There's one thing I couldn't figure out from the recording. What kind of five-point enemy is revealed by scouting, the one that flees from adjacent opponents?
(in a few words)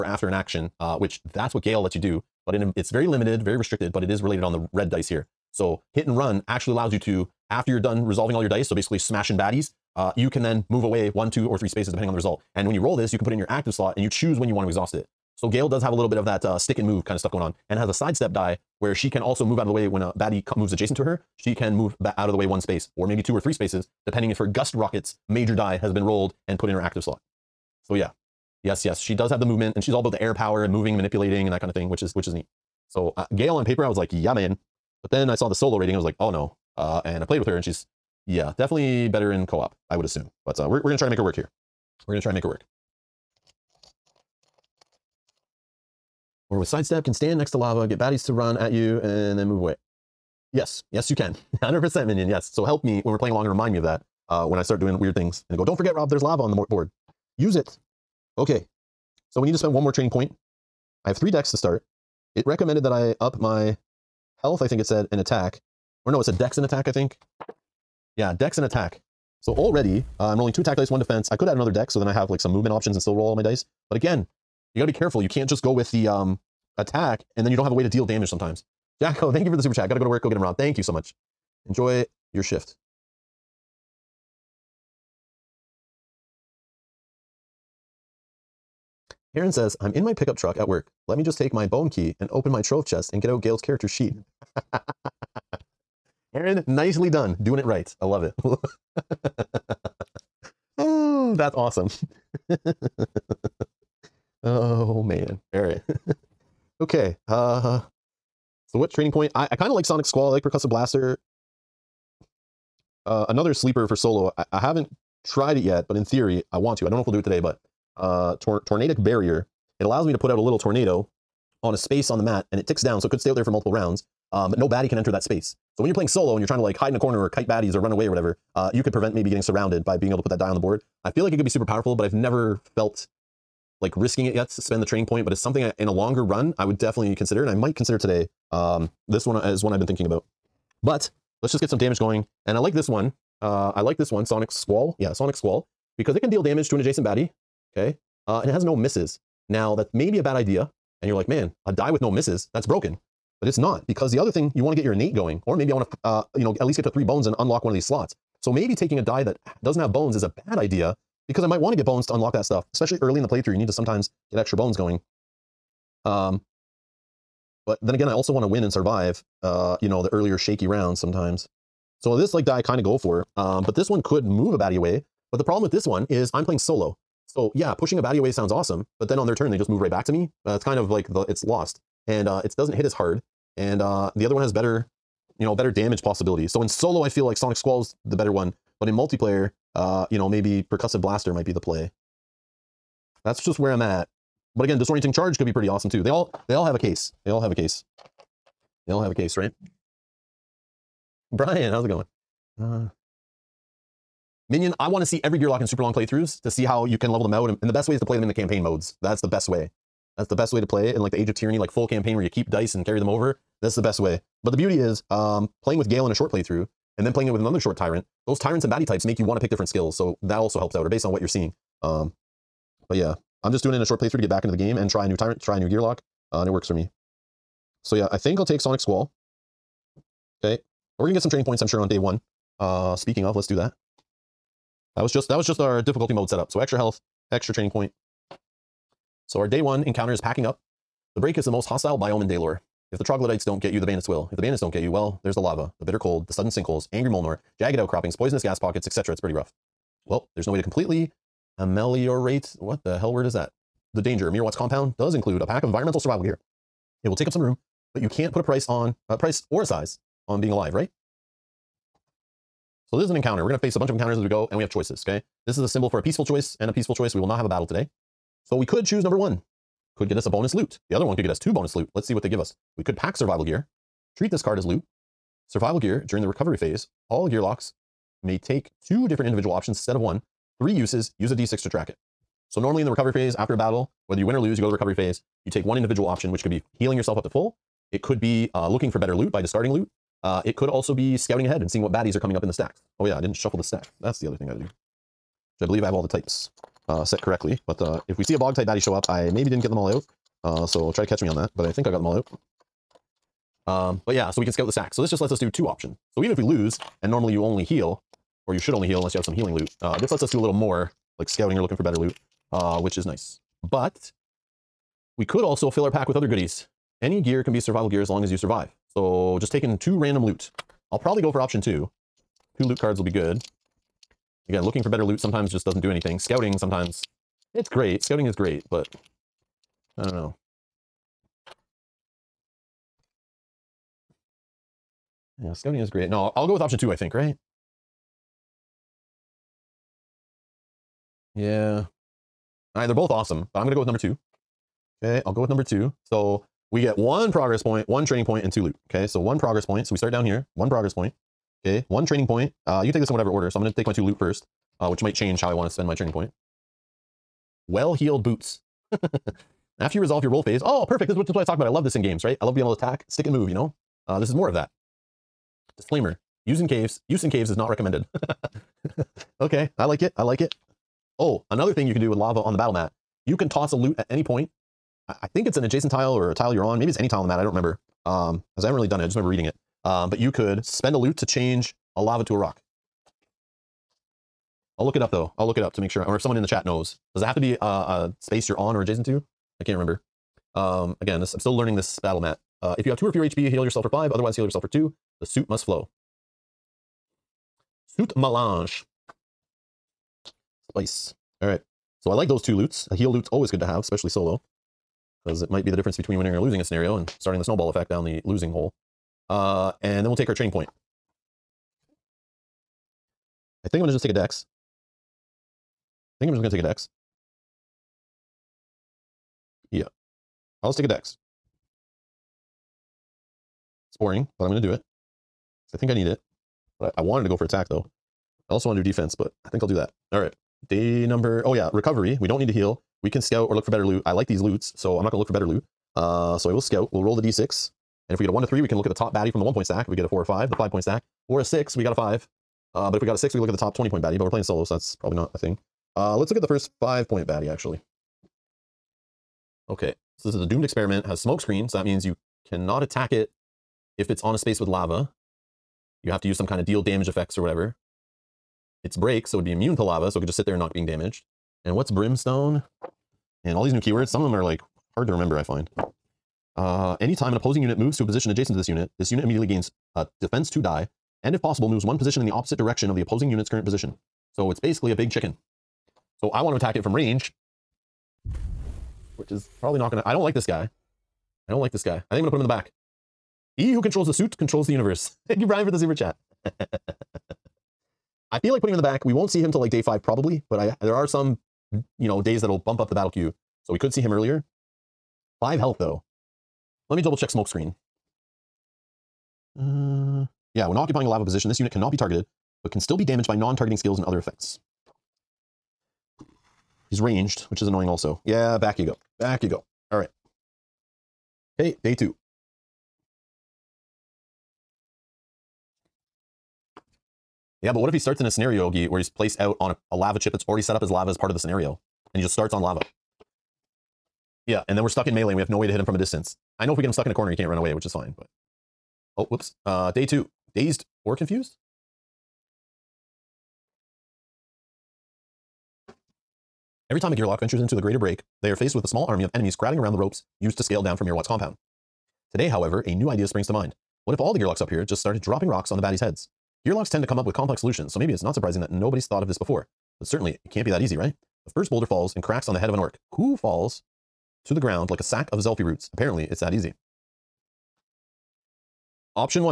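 doomed experiment.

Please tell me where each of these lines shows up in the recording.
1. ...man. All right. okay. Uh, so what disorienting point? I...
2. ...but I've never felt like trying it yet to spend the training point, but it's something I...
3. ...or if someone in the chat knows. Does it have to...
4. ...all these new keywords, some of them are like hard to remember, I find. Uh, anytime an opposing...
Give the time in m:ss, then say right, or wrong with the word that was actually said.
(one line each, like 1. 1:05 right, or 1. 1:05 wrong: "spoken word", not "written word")
1. 1:45 wrong: "training", not "disorienting"
2. 2:11 wrong: "risking", not "trying"
3. 6:26 right
4. 7:43 right.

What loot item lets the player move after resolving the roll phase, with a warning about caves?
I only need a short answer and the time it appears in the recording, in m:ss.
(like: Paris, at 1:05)
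Well-heeled boots, at 5:57.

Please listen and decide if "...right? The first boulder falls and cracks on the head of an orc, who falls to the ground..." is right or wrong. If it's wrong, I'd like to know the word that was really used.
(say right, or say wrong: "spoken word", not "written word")
right.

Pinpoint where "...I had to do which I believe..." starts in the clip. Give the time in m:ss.
4:54.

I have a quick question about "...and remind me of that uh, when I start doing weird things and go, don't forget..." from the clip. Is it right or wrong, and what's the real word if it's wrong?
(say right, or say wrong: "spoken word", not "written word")
right.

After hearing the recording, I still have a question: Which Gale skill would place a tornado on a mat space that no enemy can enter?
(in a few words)
Tornadic Barrier.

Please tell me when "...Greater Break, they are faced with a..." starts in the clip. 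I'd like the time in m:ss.
8:57.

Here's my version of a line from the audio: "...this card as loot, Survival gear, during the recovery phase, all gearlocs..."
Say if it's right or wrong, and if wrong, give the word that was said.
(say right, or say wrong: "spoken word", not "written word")
right.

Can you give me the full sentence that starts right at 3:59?
So our day one encounter is packing up.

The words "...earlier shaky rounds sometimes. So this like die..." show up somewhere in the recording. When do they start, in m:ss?
2:50.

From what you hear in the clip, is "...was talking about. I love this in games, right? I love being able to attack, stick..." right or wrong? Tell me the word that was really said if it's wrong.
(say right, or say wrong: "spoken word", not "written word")
right.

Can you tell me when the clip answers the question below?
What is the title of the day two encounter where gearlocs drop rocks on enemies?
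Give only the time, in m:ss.
8:50.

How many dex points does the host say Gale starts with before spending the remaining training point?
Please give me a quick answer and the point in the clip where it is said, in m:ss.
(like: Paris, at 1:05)
3, at 1:01.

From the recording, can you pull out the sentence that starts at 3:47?
So yeah, I think I'll take Sonic Squall.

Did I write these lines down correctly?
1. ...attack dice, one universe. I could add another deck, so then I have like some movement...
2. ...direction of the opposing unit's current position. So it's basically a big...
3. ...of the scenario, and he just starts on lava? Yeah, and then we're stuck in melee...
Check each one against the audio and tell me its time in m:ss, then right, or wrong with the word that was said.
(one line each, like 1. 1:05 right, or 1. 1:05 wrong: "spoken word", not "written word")
1. 1:10 wrong: "defense", not "universe"
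2. 7:52 right
3. 8:41 right.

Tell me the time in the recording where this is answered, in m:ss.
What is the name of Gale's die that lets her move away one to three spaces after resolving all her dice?
0:05.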